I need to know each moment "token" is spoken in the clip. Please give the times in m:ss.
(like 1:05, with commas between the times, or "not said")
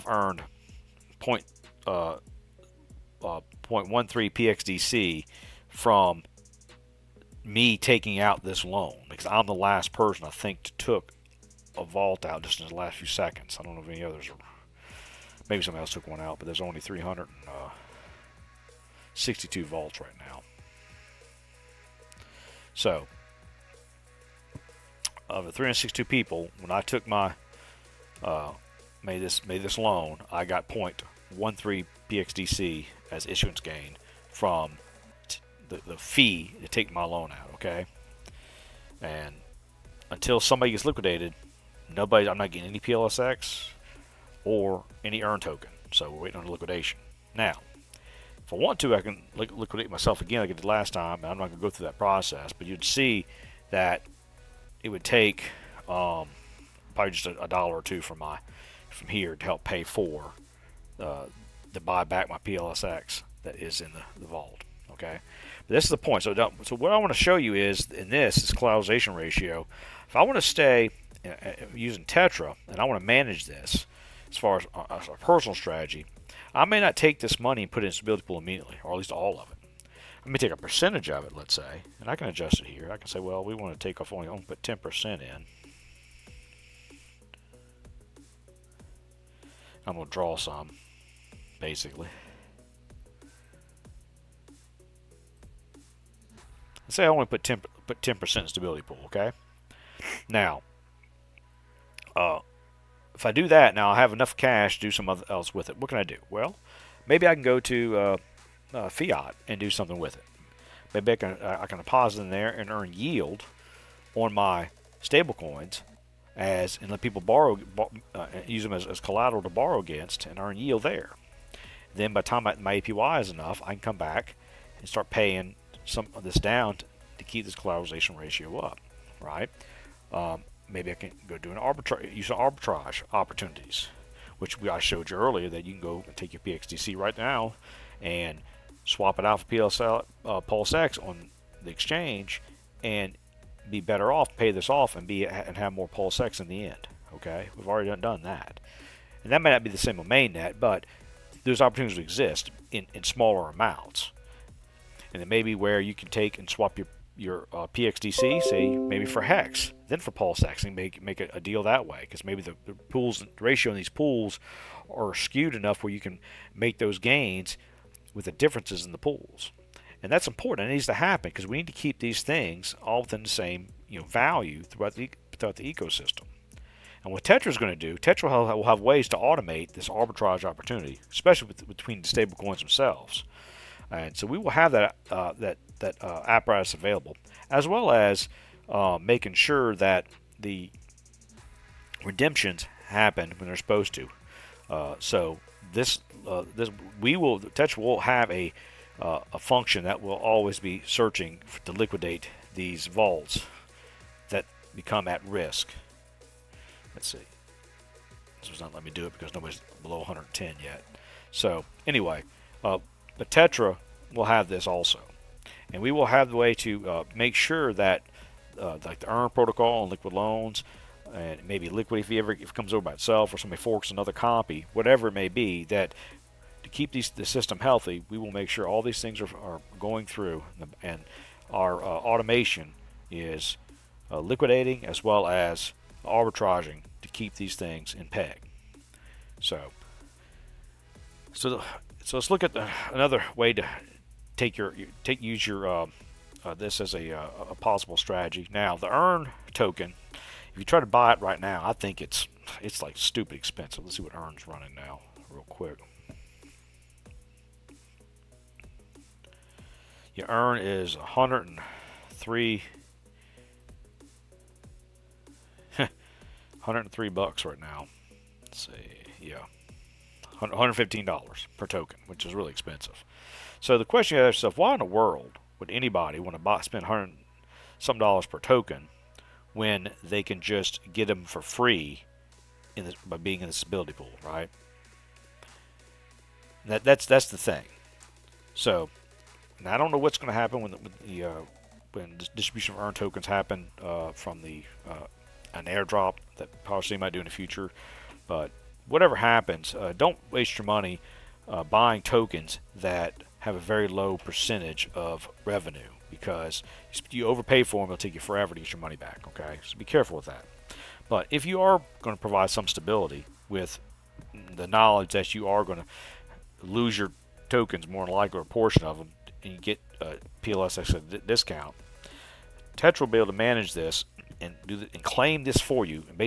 0:45, 4:09, 4:31, 4:38, 4:52, 5:02, 5:17.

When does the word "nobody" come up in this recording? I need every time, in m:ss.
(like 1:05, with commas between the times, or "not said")
0:41, 3:29.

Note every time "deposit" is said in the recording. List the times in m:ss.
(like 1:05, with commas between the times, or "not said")
1:51.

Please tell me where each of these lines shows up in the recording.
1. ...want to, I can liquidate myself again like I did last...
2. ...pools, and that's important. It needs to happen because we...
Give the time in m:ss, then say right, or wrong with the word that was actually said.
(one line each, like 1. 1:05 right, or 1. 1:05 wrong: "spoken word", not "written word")
1. 0:48 right
2. 2:48 right.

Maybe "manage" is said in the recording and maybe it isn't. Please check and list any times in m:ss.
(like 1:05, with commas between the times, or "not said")
1:13, 5:23.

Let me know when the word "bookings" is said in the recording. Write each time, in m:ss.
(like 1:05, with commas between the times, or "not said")
not said.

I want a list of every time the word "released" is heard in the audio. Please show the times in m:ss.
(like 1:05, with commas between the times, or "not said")
not said.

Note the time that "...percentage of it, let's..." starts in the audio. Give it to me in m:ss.
1:20.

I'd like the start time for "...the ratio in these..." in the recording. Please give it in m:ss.
2:43.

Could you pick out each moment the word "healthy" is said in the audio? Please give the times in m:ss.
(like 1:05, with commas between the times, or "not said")
3:47.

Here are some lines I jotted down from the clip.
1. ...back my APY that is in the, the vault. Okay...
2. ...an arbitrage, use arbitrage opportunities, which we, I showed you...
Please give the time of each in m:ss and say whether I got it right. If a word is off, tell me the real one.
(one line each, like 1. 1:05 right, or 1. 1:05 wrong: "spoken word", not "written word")
1. 1:02 wrong: "PLSX", not "APY"
2. 2:11 right.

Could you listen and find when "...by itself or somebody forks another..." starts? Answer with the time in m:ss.
3:42.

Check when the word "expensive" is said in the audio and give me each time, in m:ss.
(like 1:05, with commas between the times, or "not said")
4:13, 4:32.